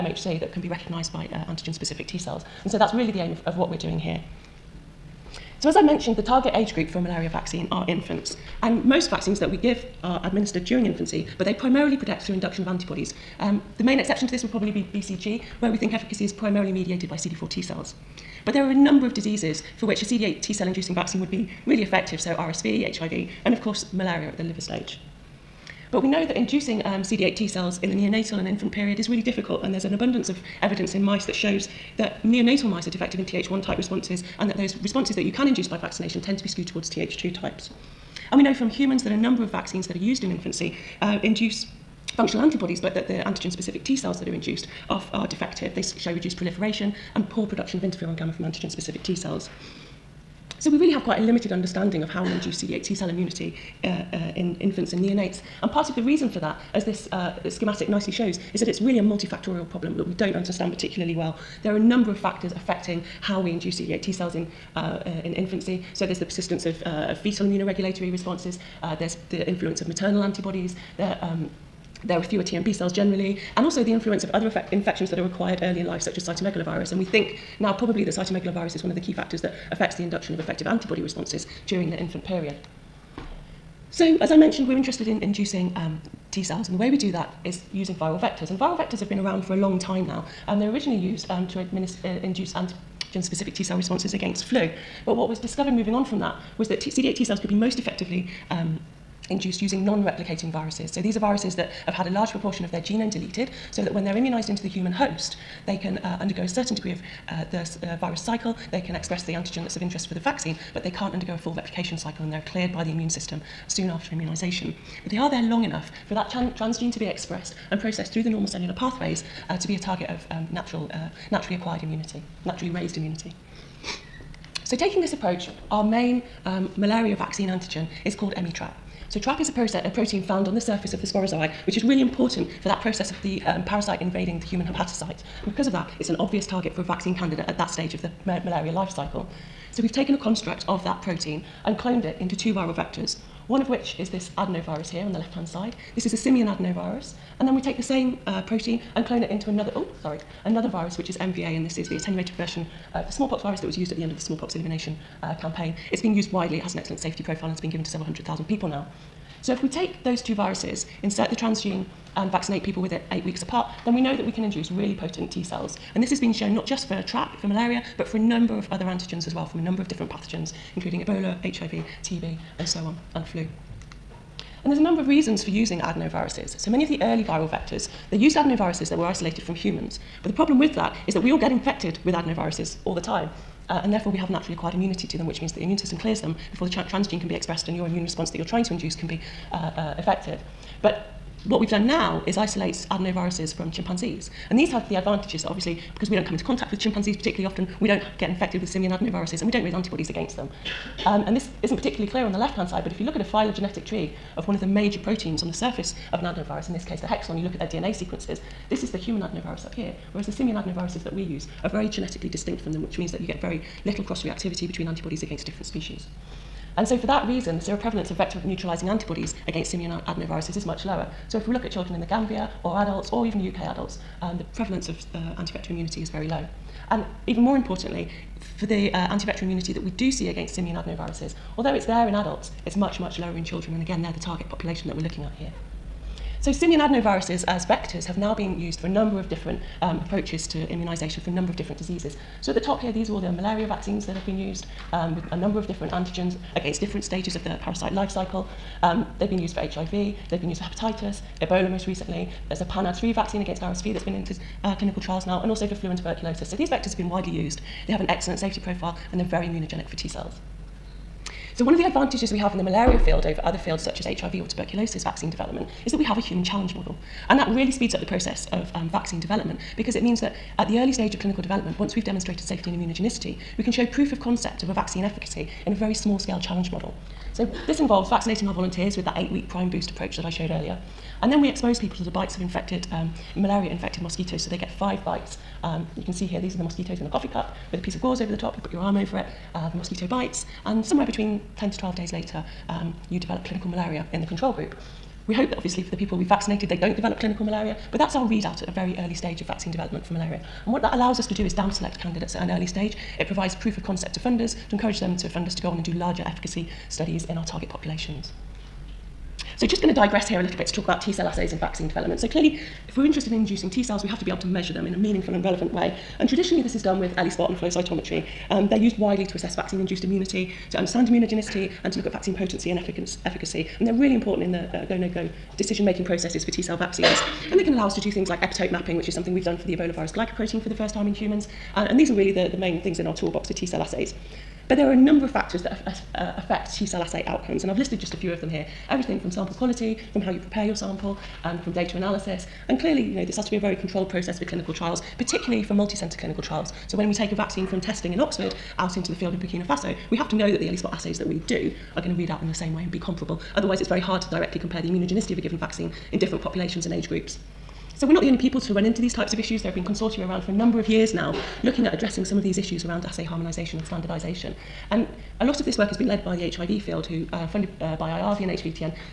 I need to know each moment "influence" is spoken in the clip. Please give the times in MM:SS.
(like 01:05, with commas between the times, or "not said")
01:09, 01:13.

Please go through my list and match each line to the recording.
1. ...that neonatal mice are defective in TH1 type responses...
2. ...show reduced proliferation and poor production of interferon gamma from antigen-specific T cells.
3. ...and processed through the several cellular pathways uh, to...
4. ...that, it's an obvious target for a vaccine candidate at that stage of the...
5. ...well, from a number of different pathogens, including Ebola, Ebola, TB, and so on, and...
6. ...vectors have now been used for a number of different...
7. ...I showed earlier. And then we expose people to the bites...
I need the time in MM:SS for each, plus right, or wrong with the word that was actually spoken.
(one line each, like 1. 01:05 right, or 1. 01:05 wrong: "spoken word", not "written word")
1. 00:31 right
2. 00:45 right
3. 01:57 wrong: "normal", not "several"
4. 02:15 right
5. 02:49 wrong: "HIV", not "Ebola"
6. 03:57 right
7. 04:40 right.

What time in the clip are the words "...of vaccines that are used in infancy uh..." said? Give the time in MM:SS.
00:39.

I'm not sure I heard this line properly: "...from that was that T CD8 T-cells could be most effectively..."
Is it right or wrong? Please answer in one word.
right.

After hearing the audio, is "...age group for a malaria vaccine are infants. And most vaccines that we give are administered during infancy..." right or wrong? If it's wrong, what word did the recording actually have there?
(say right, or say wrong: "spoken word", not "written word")
right.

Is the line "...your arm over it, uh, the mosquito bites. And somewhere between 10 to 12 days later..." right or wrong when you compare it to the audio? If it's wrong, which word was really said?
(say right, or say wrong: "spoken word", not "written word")
right.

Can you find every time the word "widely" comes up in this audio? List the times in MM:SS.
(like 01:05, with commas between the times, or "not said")
02:36, 04:17, 05:18.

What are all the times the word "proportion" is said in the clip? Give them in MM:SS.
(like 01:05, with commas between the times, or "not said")
01:42.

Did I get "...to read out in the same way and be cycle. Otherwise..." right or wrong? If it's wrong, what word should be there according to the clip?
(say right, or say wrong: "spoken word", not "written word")
wrong: "comparable", not "cycle".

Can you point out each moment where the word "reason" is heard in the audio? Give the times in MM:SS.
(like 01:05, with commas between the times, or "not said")
00:56, 02:55, 03:37.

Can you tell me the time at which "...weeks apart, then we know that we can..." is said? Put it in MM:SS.
02:43.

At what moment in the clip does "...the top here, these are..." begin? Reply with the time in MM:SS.
04:02.